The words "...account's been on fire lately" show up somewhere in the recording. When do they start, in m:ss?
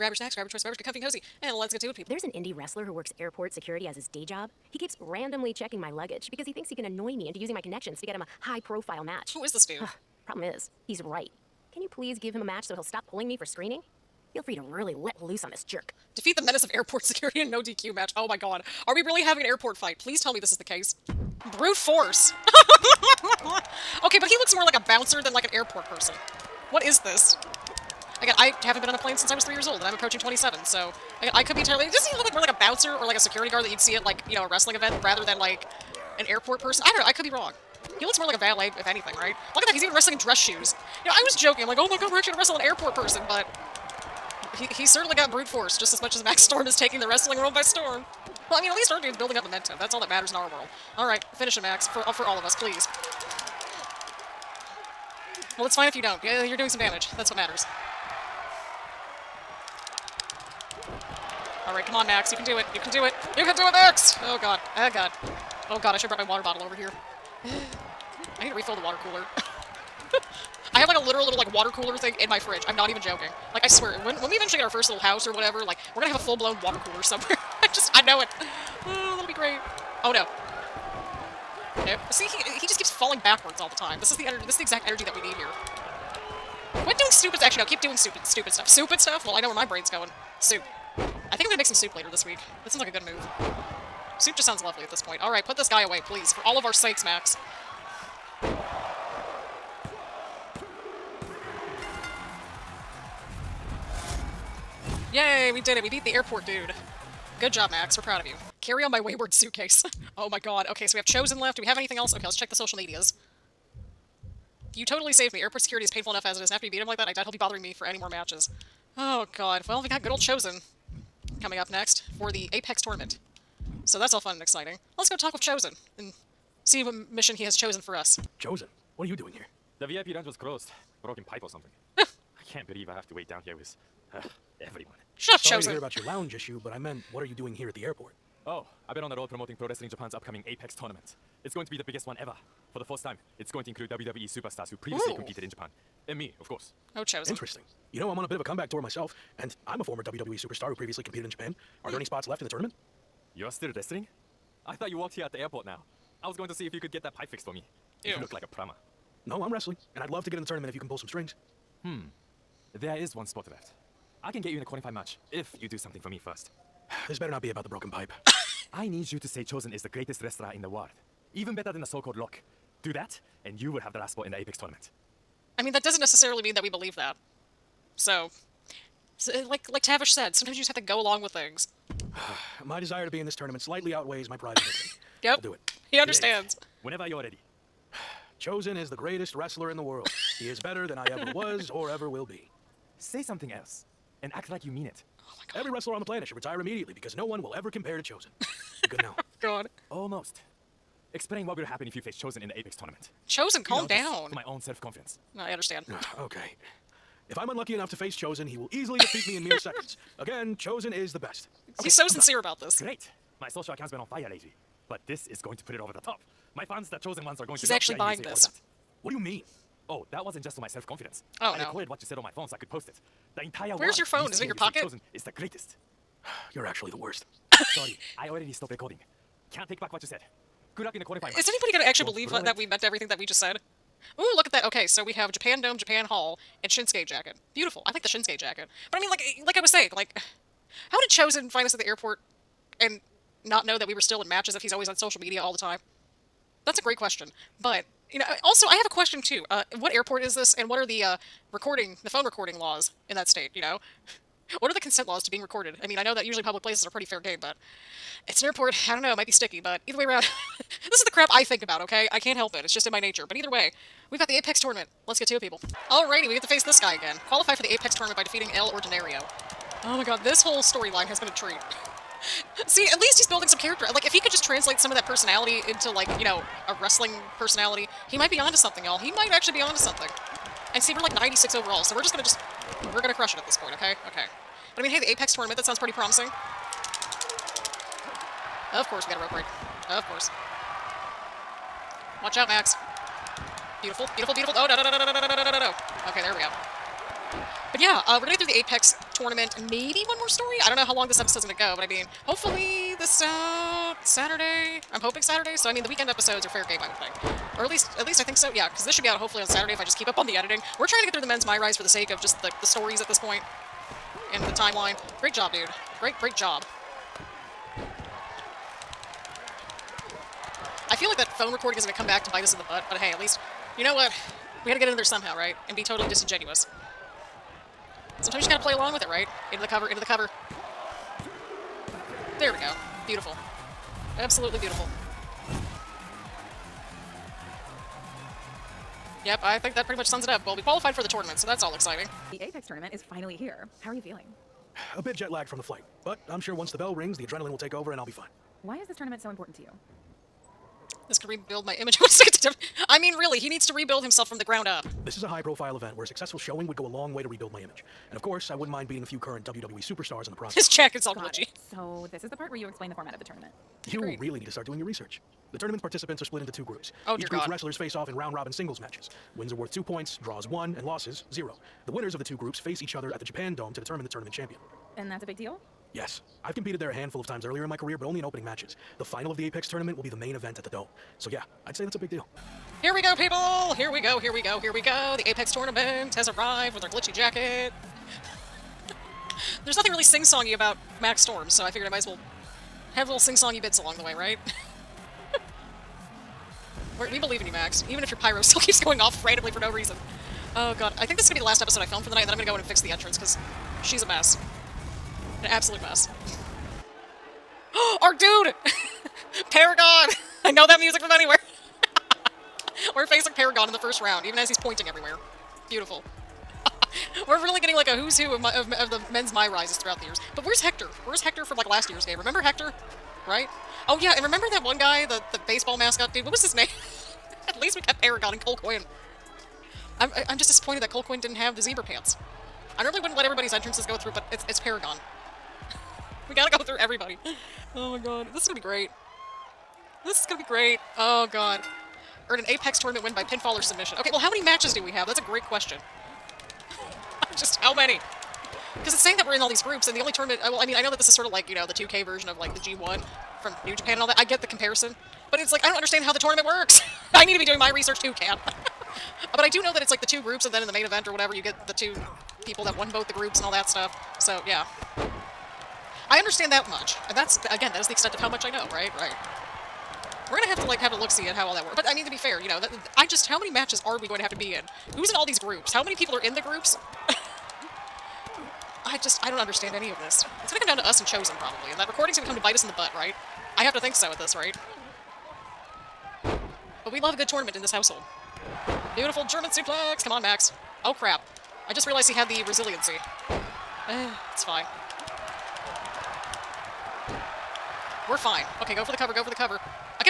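3:33.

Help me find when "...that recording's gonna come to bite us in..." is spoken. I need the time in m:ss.
8:01.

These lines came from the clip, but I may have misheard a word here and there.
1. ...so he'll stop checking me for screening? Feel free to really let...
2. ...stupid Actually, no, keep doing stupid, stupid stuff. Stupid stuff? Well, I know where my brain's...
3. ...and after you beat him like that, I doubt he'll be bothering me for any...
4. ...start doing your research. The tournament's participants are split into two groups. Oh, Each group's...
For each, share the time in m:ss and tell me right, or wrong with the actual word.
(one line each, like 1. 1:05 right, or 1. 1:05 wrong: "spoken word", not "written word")
1. 0:12 wrong: "pulling", not "checking"
2. 1:27 right
3. 1:56 right
4. 6:04 right.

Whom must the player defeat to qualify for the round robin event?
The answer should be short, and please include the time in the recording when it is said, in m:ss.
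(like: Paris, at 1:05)
El Ordinario, at 4:28.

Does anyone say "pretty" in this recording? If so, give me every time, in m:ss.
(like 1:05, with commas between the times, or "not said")
4:16, 4:45, 5:39.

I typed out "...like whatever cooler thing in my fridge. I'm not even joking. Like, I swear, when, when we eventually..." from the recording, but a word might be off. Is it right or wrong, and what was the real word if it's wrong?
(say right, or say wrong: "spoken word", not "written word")
wrong: "water", not "whatever".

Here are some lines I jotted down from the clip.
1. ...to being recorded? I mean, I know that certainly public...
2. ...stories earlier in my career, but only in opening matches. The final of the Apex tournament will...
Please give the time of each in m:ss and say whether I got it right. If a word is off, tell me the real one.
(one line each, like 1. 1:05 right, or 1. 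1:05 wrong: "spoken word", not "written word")
1. 4:15 wrong: "usually", not "certainly"
2. 6:17 wrong: "times", not "stories".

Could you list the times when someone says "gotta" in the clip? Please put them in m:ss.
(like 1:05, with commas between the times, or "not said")
5:28, 7:16.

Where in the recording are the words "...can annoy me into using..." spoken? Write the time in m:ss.
0:06.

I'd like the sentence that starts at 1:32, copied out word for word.
That sounds like a good move.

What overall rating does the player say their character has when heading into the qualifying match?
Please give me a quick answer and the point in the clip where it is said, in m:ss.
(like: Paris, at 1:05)
96, at 4:41.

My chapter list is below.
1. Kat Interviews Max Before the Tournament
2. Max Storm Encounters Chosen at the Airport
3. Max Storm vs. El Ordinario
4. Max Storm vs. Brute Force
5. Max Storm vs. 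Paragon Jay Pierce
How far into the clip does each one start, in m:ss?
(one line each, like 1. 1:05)
1. 5:42
2. 2:07
3. 4:25
4. 0:21
5. 6:22.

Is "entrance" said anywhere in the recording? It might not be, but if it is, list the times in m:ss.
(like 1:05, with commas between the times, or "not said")
6:42, 7:13.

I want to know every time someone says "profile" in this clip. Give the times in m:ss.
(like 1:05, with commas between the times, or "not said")
0:08, 5:55.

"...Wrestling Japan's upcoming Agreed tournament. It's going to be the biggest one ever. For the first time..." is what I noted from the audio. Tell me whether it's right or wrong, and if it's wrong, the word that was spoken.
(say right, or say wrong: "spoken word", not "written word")
wrong: "Apex", not "Agreed".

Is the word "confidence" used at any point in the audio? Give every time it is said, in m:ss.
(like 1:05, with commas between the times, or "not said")
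3:24, 3:40.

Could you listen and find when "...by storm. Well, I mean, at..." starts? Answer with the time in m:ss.
0:47.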